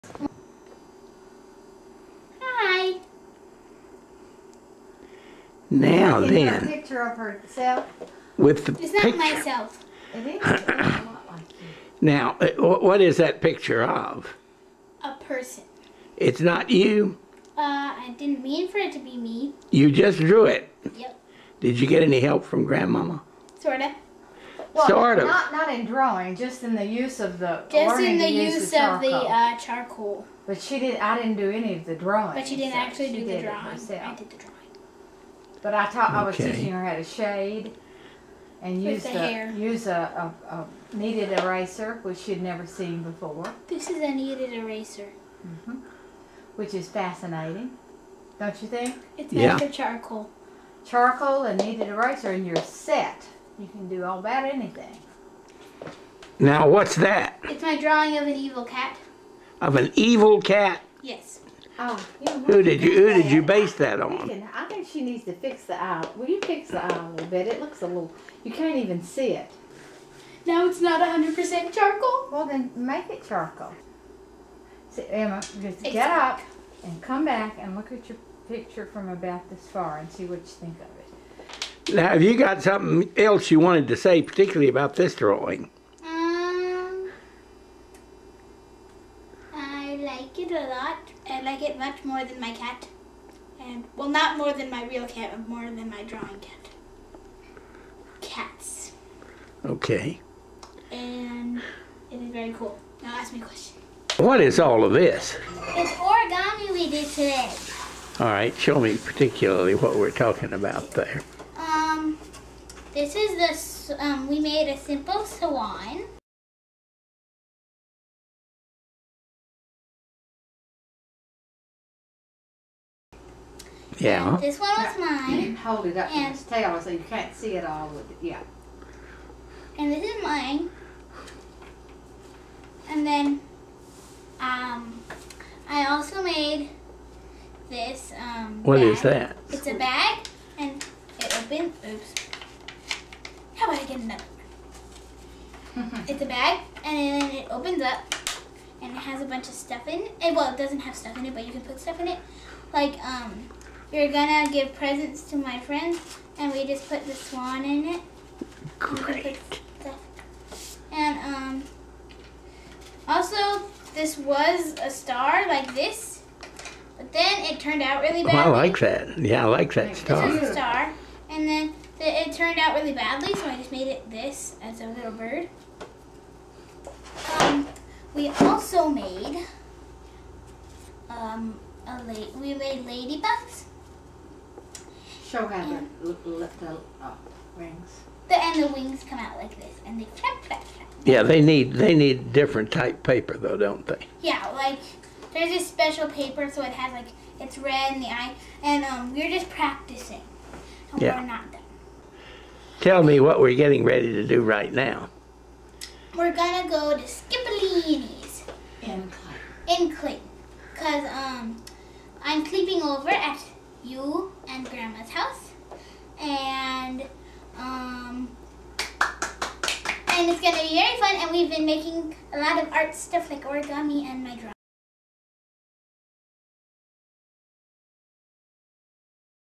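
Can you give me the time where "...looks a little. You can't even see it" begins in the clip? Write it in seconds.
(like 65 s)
67 s.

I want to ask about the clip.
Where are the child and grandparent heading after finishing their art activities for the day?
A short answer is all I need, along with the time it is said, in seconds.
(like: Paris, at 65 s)
Skippolini's, at 207 s.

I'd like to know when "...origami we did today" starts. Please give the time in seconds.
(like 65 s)
105 s.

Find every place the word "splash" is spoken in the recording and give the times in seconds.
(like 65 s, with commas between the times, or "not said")
not said.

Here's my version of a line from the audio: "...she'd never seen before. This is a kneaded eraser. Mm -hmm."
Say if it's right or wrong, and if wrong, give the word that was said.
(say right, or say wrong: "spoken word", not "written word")
right.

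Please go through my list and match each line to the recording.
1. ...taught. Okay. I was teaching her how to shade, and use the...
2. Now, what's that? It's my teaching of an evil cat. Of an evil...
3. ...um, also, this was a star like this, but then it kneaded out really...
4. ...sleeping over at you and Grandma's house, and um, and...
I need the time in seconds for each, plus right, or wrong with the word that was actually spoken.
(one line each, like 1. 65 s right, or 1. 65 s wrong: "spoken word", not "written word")
1. 35 s right
2. 56 s wrong: "drawing", not "teaching"
3. 161 s wrong: "turned", not "kneaded"
4. 212 s right.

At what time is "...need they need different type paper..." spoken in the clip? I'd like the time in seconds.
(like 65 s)
191 s.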